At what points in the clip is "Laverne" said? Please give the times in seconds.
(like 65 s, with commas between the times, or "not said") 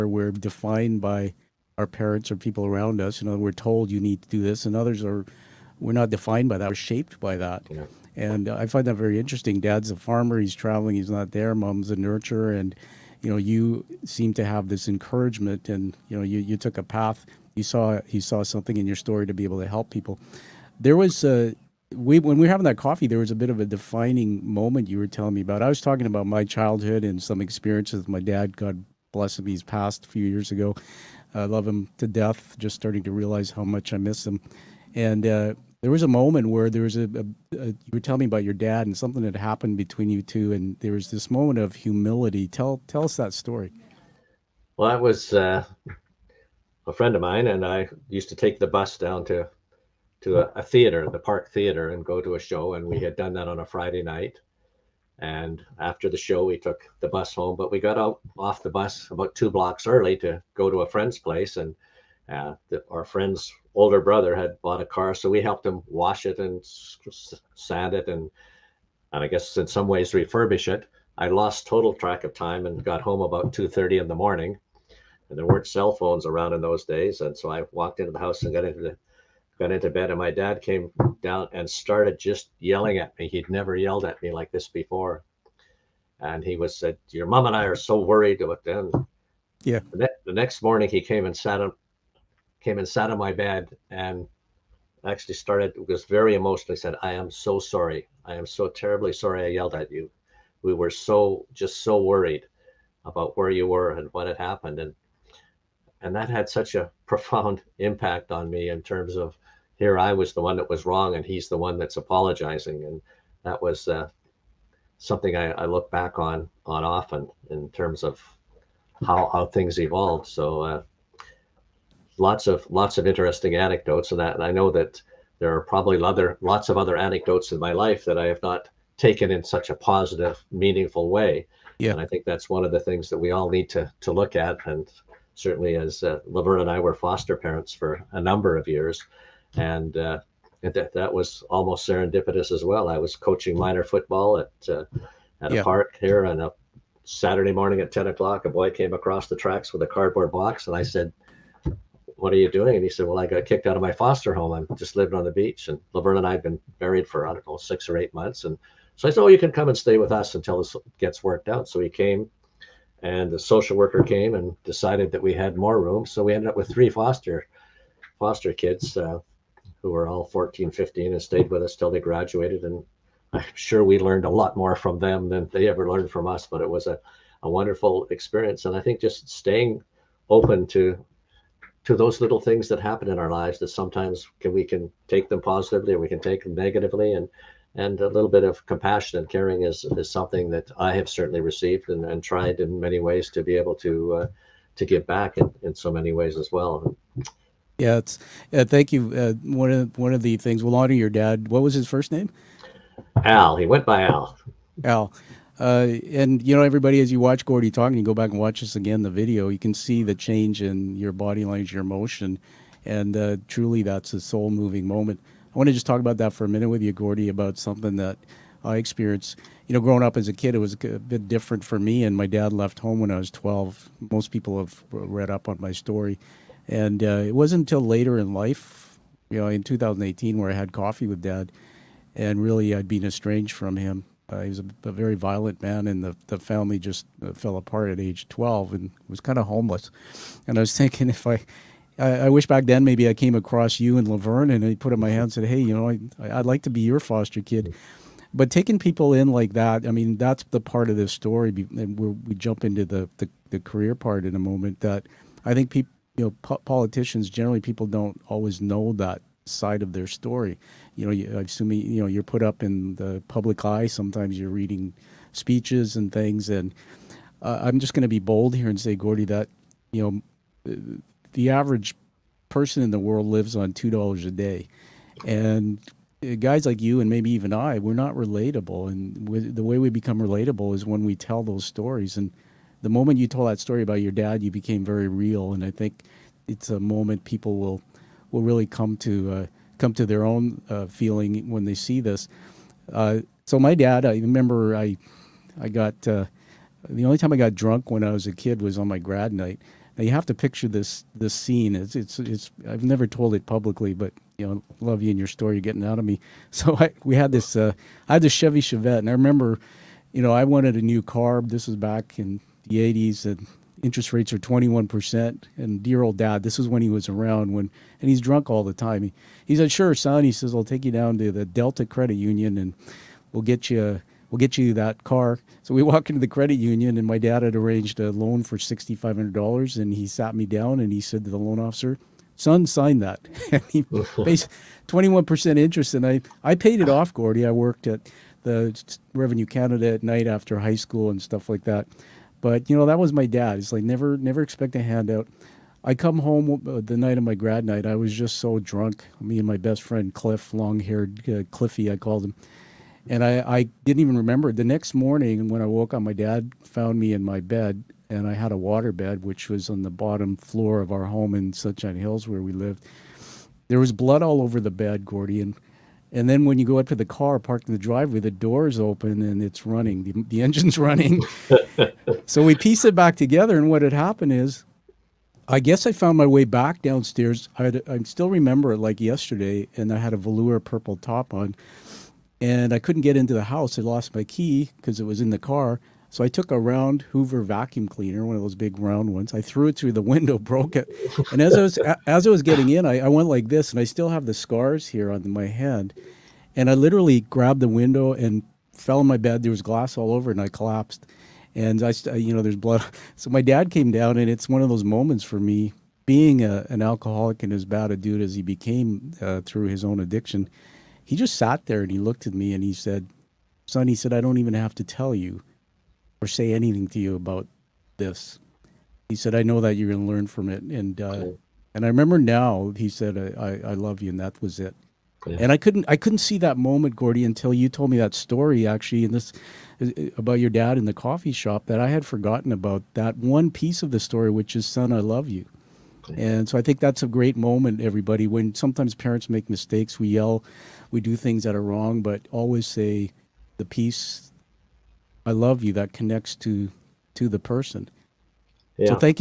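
136 s, 155 s, 244 s.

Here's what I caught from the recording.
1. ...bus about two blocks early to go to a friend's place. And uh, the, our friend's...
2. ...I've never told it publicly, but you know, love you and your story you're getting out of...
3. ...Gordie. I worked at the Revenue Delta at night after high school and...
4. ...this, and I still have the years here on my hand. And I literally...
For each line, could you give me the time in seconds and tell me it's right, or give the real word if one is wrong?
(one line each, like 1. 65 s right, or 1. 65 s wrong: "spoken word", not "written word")
1. 58 s right
2. 302 s right
3. 337 s wrong: "Canada", not "Delta"
4. 393 s wrong: "scars", not "years".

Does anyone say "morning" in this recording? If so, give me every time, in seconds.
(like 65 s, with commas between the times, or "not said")
74 s, 90 s, 147 s, 354 s.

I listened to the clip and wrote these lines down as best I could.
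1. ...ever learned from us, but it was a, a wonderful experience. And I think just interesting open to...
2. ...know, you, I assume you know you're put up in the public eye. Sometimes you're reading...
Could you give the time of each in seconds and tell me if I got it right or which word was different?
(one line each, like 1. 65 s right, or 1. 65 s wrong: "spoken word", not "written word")
1. 175 s wrong: "staying", not "interesting"
2. 261 s right.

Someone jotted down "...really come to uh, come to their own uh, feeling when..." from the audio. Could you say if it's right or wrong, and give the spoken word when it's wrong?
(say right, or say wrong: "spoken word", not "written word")
right.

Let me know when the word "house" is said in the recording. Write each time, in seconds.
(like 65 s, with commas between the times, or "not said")
78 s, 383 s.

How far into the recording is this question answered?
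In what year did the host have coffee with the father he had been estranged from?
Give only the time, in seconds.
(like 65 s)
229 s.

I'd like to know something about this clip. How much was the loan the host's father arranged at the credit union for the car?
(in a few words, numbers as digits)
$6,500.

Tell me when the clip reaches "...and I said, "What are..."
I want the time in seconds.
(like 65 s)
150 s.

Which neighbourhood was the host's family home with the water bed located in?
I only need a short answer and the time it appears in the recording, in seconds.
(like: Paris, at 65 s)
Sunshine Hills, at 361 s.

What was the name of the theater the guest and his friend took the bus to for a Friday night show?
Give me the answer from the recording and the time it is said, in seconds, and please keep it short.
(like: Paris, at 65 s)
Park Theater, at 51 s.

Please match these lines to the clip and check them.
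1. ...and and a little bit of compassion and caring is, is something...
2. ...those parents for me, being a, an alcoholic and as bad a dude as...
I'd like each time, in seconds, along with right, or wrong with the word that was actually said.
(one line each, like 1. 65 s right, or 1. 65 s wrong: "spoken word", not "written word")
1. 187 s right
2. 404 s wrong: "moments", not "parents".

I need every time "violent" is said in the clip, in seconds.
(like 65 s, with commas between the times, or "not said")
235 s.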